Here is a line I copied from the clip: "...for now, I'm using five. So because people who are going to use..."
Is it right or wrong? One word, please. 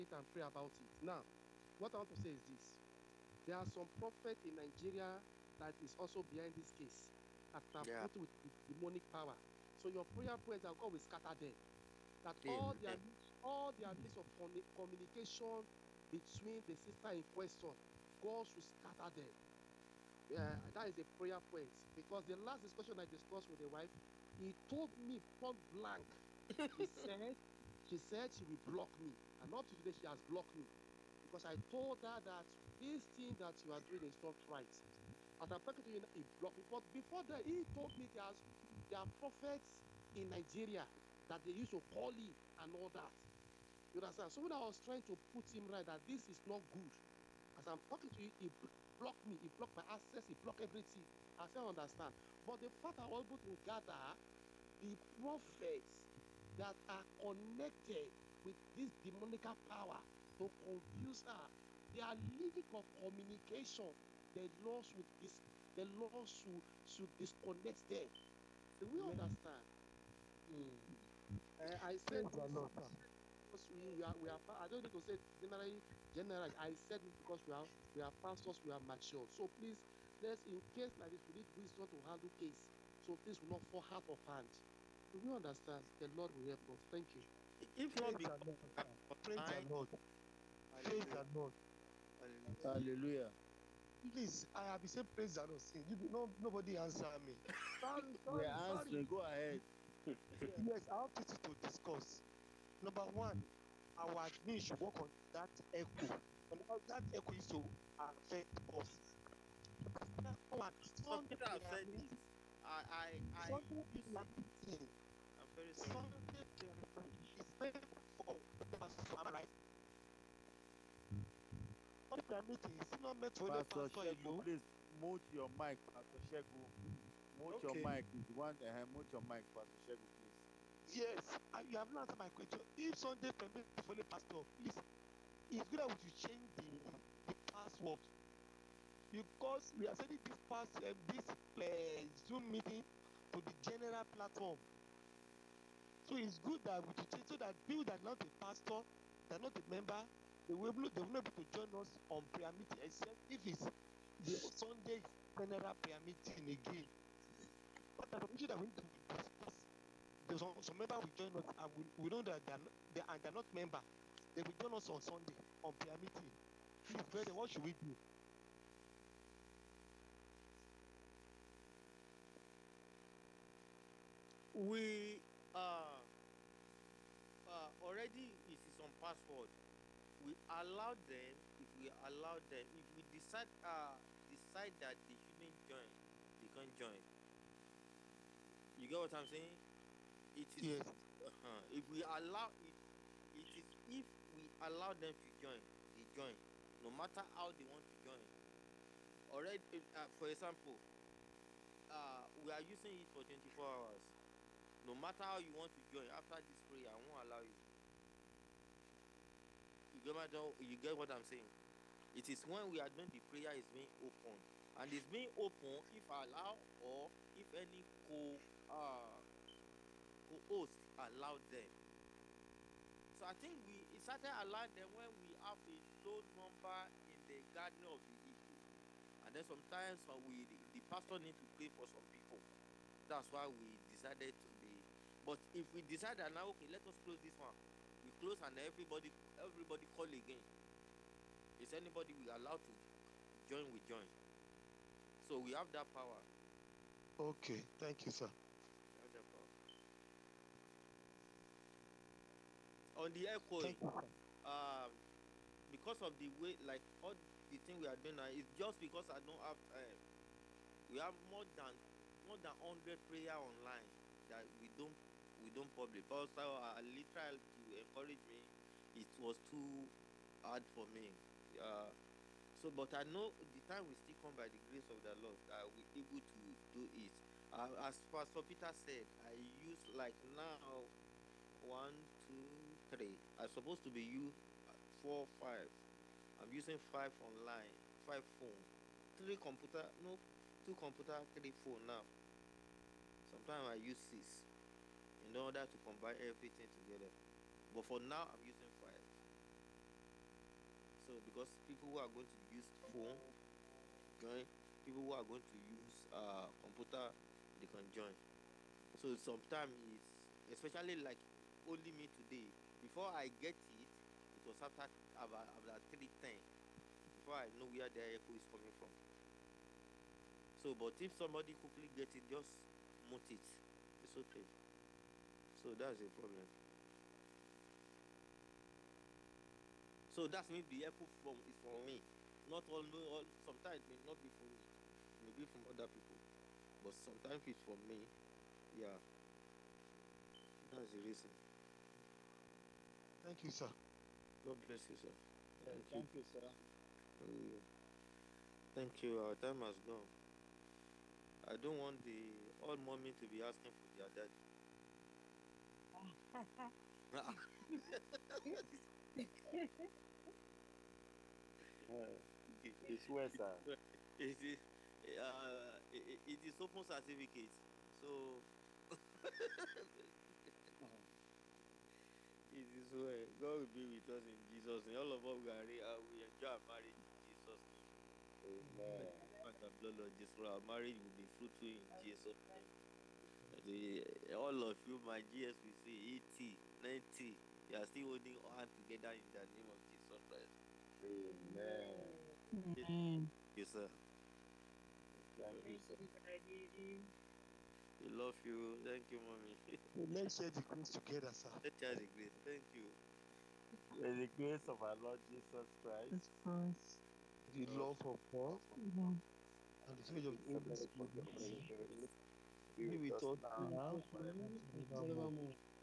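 right.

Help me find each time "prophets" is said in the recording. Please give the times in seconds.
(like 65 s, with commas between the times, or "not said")
3 s, 39 s, 55 s.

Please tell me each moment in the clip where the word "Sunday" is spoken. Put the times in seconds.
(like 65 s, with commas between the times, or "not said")
132 s, 154 s, 165 s.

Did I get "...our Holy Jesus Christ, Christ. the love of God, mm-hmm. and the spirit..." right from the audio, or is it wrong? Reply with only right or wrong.
wrong.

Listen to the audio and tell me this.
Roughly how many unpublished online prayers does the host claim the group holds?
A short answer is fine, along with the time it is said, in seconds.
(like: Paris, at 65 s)
more than 100, at 262 s.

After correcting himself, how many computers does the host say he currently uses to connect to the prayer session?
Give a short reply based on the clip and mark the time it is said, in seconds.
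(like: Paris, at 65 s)
2, at 290 s.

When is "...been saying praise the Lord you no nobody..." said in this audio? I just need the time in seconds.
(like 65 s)
94 s.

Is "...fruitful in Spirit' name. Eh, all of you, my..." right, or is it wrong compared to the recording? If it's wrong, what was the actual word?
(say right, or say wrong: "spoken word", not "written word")
wrong: "Jesus", not "Spirit".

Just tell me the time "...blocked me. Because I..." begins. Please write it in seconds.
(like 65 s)
30 s.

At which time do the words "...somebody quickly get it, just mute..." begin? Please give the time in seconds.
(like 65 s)
321 s.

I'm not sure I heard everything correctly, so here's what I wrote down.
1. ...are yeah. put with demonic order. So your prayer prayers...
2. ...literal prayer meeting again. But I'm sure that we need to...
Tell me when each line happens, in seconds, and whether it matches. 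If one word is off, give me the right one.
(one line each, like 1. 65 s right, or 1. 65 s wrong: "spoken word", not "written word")
1. 7 s wrong: "power", not "order"
2. 155 s wrong: "general", not "literal".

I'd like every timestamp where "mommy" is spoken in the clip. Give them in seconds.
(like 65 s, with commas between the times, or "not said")
352 s, 399 s.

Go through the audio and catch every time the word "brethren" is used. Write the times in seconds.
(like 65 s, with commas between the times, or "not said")
167 s.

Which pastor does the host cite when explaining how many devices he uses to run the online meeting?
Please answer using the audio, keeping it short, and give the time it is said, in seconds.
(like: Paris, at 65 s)
Pastor Peter, at 278 s.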